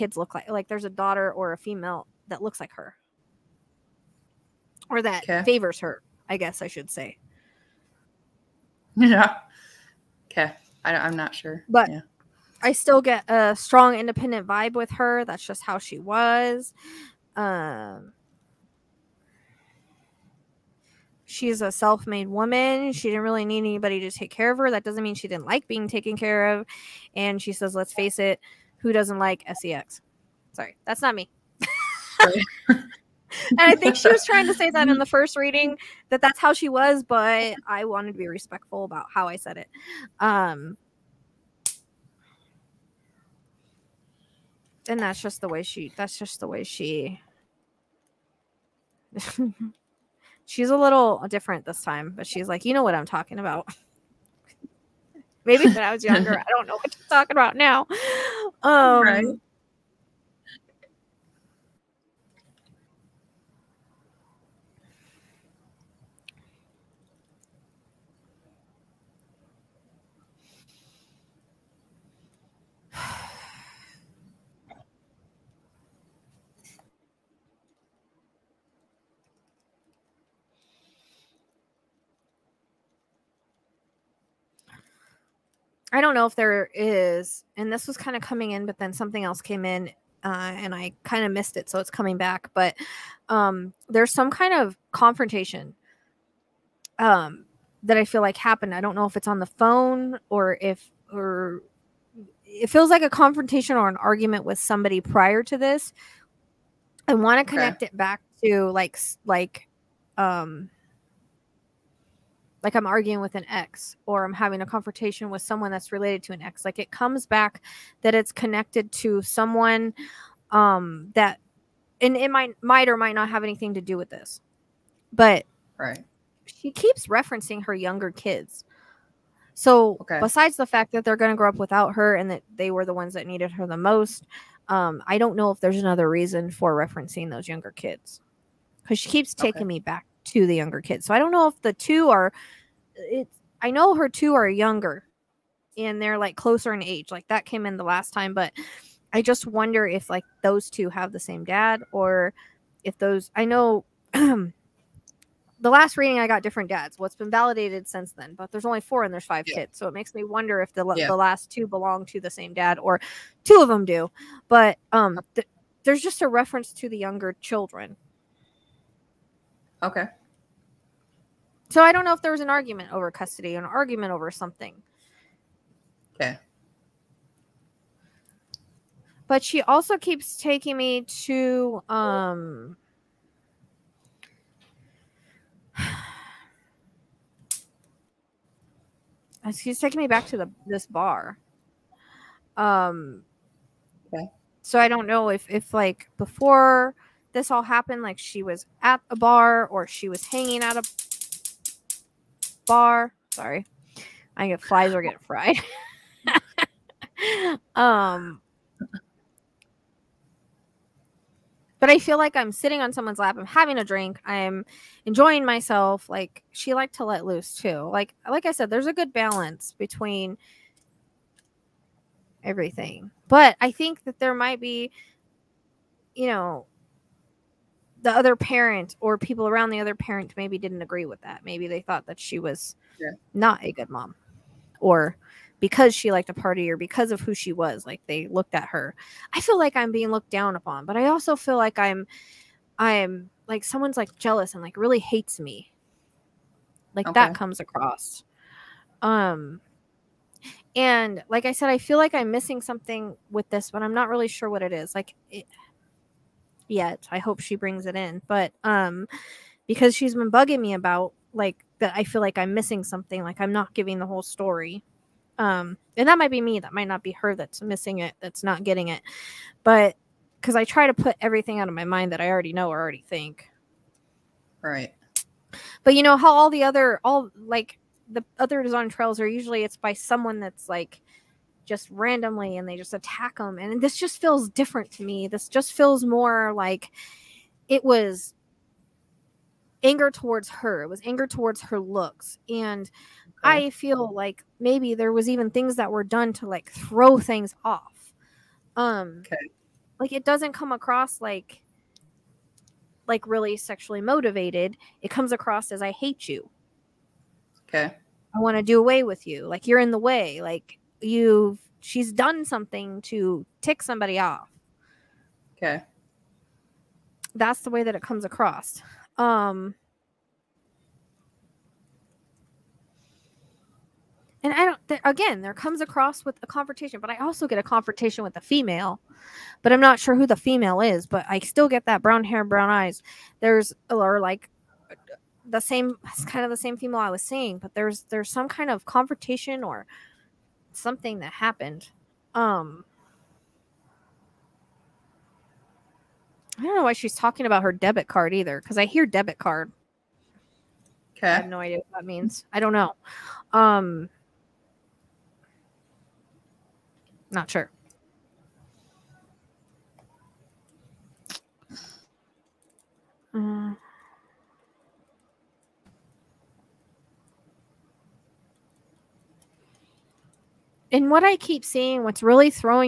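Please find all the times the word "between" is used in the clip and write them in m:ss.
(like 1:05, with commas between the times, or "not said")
3:39.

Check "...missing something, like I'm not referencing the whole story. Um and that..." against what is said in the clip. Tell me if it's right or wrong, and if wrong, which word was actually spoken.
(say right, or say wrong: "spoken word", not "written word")
wrong: "giving", not "referencing".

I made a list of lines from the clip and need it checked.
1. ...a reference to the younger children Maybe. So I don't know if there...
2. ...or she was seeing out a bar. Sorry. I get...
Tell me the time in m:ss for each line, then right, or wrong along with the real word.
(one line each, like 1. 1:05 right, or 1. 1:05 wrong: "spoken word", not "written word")
1. 2:46 wrong: "Okay", not "Maybe"
2. 3:19 wrong: "hanging", not "seeing".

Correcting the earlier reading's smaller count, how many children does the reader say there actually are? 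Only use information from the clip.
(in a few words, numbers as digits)
5.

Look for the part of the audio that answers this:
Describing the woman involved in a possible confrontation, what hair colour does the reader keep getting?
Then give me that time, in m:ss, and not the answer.
5:32.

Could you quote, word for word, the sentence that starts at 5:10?
Like you've she's done something to tick somebody off.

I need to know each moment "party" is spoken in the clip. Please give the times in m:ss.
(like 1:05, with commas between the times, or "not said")
3:56.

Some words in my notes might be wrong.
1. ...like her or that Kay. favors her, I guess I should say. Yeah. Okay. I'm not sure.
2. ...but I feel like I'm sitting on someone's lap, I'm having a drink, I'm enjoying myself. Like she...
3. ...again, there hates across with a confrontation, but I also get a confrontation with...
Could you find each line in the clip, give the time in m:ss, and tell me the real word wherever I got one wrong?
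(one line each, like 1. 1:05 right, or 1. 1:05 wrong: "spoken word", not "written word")
1. 0:02 right
2. 3:31 right
3. 5:25 wrong: "comes", not "hates".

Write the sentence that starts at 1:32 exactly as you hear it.
But um, there's some kind of confrontation um, that I feel like happened.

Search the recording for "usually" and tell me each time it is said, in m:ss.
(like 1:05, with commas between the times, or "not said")
4:39.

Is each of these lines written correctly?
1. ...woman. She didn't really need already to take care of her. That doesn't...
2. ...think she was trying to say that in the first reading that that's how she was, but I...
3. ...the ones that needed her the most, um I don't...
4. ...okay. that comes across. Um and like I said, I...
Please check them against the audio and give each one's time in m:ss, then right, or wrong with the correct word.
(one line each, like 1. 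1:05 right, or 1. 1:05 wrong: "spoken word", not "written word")
1. 0:22 wrong: "anybody", not "already"
2. 0:33 right
3. 2:12 right
4. 4:07 right.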